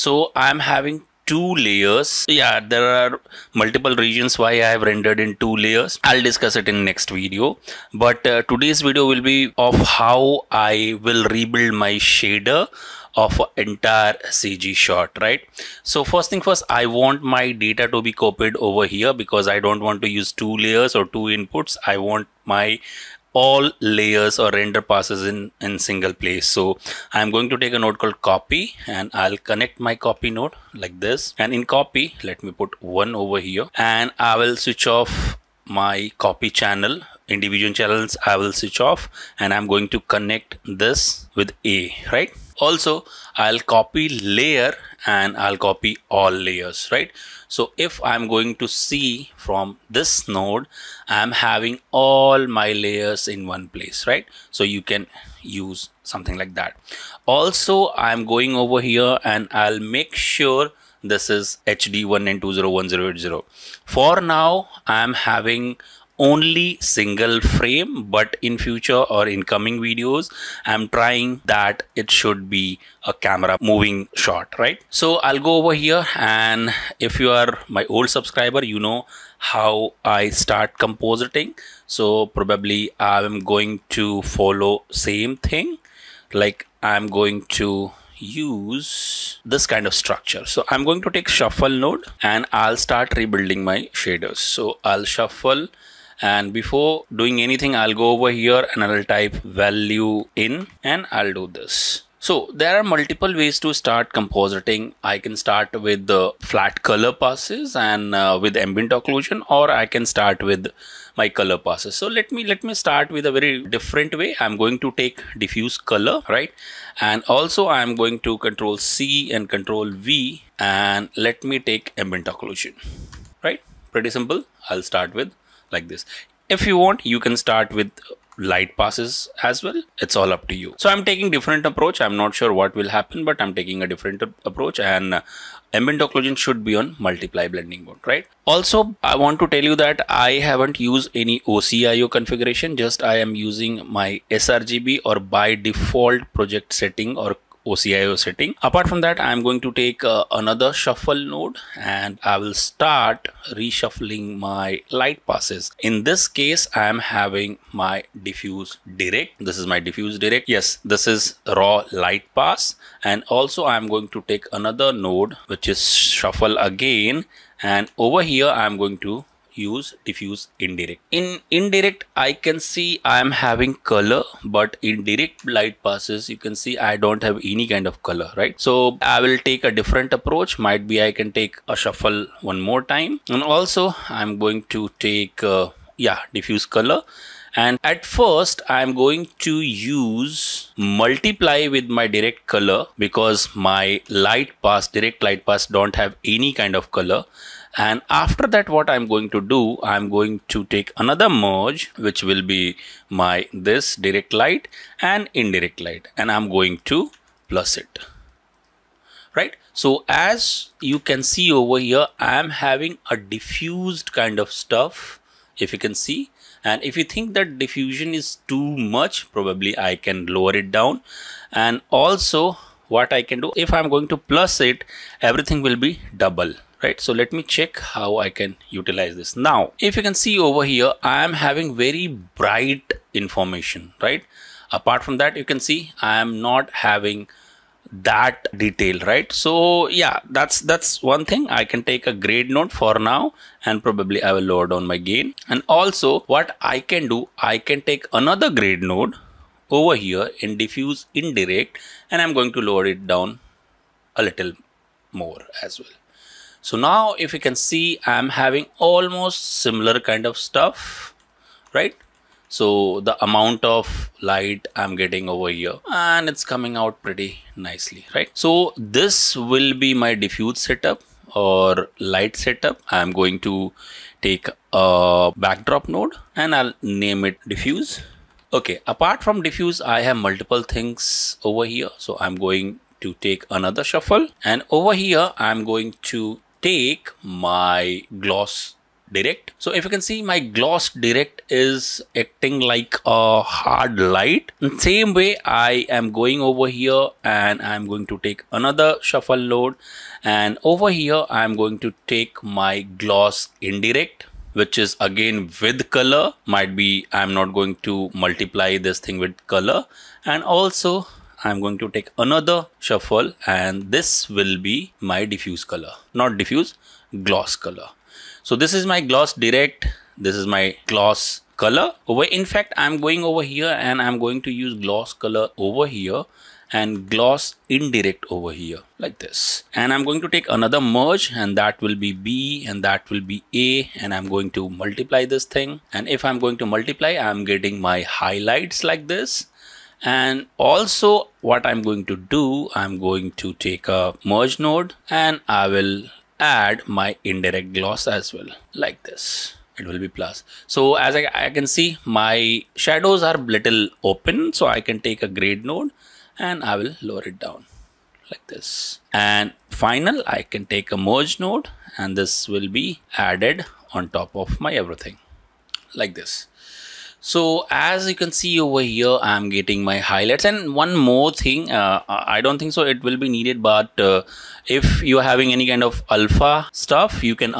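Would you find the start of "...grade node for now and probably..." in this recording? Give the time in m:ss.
4:02.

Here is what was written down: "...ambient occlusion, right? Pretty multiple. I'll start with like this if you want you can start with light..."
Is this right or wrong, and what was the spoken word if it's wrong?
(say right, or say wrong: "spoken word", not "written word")
wrong: "simple", not "multiple".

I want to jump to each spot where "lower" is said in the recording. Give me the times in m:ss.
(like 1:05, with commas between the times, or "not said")
3:40, 4:04, 4:12, 5:57.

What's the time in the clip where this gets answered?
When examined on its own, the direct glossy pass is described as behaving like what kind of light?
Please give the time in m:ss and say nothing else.
4:53.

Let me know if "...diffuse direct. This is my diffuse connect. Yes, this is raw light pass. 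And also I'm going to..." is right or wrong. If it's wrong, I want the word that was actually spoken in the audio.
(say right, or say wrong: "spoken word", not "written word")
wrong: "direct", not "connect".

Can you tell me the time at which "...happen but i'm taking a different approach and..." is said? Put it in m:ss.
2:12.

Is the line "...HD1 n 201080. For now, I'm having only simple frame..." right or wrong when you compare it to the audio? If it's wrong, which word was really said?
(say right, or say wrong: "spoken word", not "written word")
wrong: "single", not "simple".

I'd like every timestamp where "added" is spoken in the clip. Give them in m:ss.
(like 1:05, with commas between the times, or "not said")
6:03.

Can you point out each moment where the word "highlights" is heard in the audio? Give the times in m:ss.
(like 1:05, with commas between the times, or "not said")
5:38, 6:09.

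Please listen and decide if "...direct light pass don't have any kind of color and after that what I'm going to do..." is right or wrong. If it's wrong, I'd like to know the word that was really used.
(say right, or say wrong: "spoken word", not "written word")
right.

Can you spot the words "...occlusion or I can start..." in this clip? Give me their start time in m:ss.
1:48.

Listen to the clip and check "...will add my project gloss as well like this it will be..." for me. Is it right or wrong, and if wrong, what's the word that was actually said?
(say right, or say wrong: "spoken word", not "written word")
wrong: "indirect", not "project".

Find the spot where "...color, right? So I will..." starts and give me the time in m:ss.
2:58.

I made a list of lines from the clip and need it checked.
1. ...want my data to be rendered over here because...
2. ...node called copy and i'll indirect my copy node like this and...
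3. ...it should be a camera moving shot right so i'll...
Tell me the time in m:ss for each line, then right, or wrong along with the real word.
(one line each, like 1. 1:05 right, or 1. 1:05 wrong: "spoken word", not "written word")
1. 0:16 wrong: "copied", not "rendered"
2. 0:27 wrong: "connect", not "indirect"
3. 1:11 right.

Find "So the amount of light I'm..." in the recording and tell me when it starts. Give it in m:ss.
4:22.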